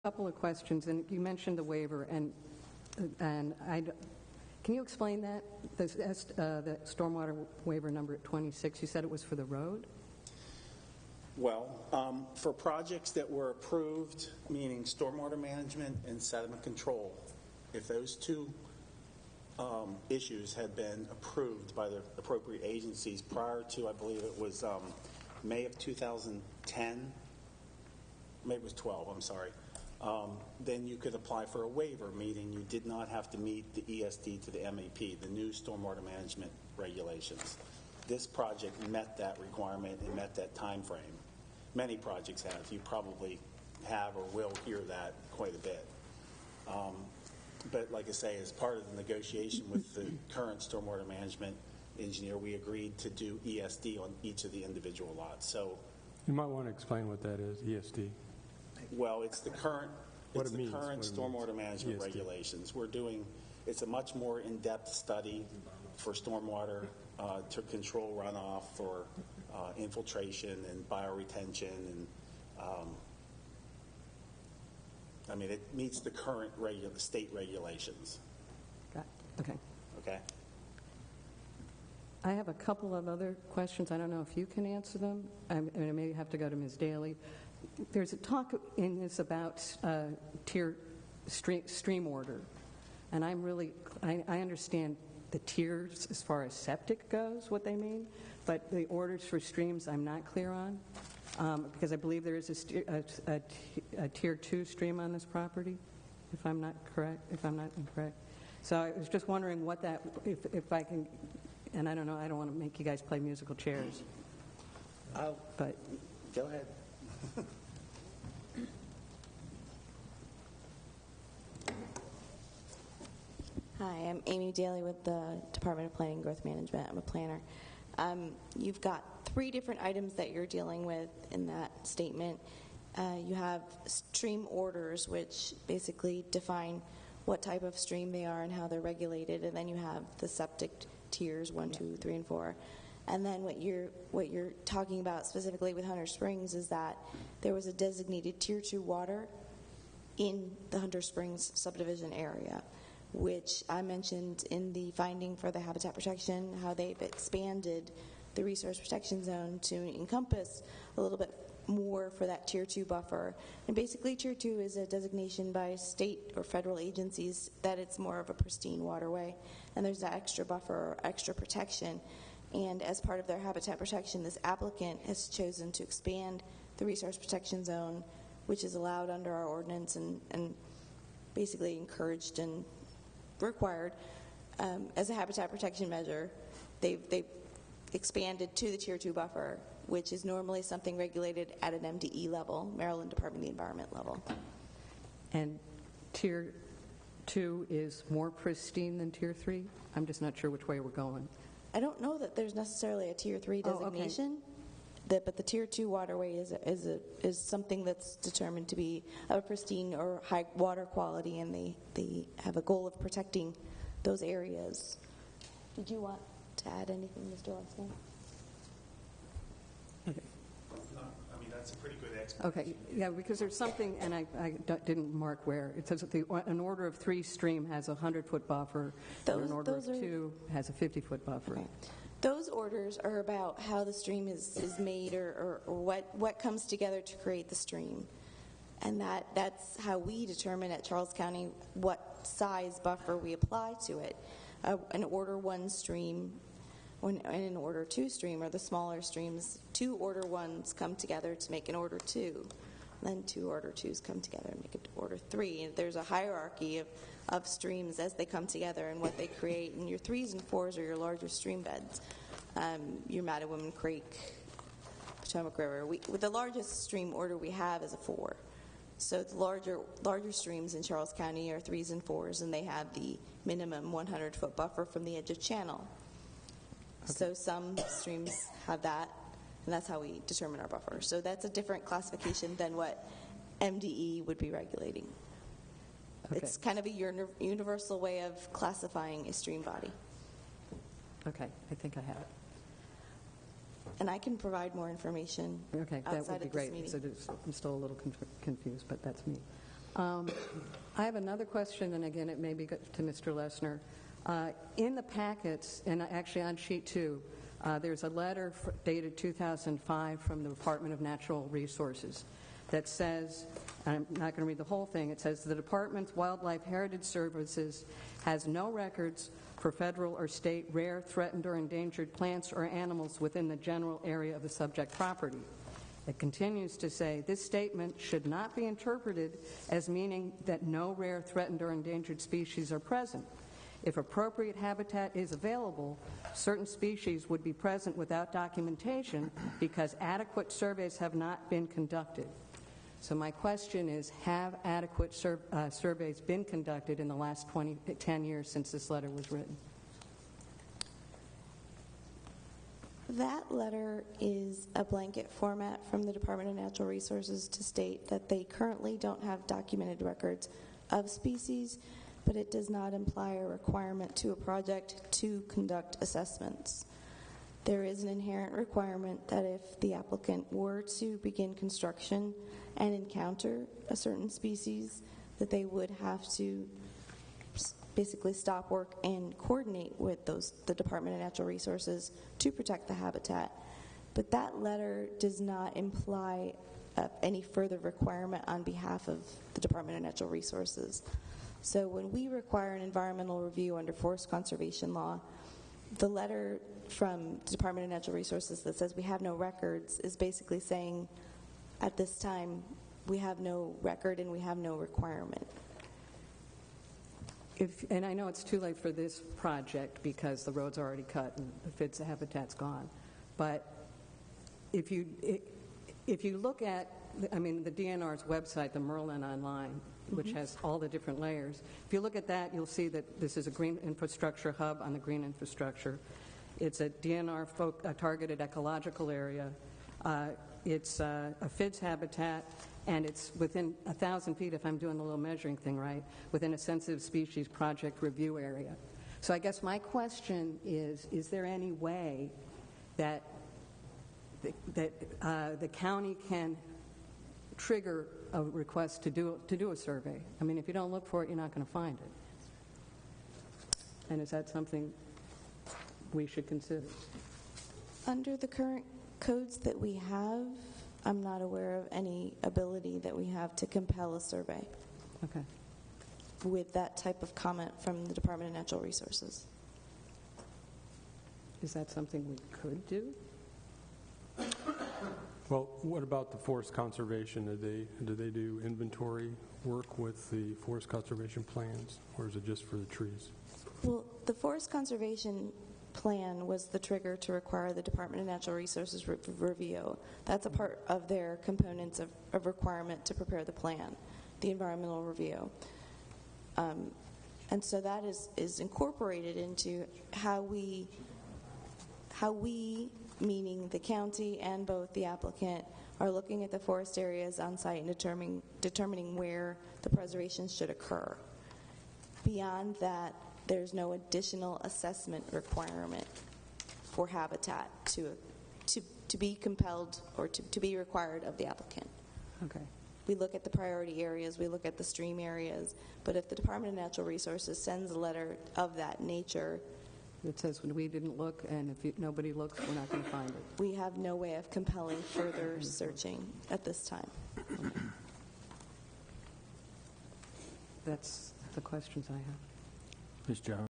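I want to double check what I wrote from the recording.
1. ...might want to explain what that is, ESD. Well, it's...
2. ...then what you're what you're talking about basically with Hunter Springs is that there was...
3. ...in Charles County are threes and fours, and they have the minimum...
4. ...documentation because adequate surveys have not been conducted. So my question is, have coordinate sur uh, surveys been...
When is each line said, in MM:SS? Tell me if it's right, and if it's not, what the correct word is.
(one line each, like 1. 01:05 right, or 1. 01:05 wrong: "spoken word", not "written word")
1. 00:56 right
2. 02:23 wrong: "specifically", not "basically"
3. 04:30 right
4. 05:38 wrong: "adequate", not "coordinate".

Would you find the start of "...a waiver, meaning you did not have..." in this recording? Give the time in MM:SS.
00:31.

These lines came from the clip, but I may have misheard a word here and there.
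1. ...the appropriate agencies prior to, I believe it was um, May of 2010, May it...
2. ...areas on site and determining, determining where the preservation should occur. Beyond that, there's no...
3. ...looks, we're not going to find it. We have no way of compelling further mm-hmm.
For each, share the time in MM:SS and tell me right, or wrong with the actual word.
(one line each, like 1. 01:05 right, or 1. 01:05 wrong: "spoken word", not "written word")
1. 00:21 right
2. 08:26 right
3. 08:52 right.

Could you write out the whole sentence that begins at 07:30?
I mean, if you don't look for it, you're not going to find it.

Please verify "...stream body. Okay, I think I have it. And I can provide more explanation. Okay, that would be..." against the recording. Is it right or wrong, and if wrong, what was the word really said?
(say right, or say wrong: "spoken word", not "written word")
wrong: "information", not "explanation".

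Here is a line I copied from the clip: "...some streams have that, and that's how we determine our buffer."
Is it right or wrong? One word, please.
right.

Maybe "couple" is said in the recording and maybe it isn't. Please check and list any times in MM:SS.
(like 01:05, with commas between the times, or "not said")
00:00, 01:22.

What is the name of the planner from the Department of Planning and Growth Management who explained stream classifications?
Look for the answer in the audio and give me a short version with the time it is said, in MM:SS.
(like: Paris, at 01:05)
Amy Daly, at 02:04.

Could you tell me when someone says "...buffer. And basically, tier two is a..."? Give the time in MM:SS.
02:42.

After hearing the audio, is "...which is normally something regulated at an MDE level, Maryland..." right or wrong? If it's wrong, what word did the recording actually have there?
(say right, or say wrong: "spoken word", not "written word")
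right.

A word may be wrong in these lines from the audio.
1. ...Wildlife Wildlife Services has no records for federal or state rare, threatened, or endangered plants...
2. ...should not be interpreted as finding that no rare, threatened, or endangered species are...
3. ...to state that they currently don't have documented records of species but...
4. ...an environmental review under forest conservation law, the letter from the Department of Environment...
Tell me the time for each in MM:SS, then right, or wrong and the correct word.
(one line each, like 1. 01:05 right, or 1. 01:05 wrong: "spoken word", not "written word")
1. 05:16 wrong: "Heritage", not "Wildlife"
2. 05:27 wrong: "meaning", not "finding"
3. 05:57 right
4. 06:32 wrong: "Natural", not "Environment".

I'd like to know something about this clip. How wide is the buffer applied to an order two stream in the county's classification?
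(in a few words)
50 feet.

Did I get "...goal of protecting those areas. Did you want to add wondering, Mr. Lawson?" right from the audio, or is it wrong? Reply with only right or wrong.
wrong.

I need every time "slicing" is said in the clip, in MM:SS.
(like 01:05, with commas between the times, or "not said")
not said.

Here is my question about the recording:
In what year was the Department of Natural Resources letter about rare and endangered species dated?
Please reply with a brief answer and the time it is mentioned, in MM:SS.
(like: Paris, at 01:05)
2005, at 05:09.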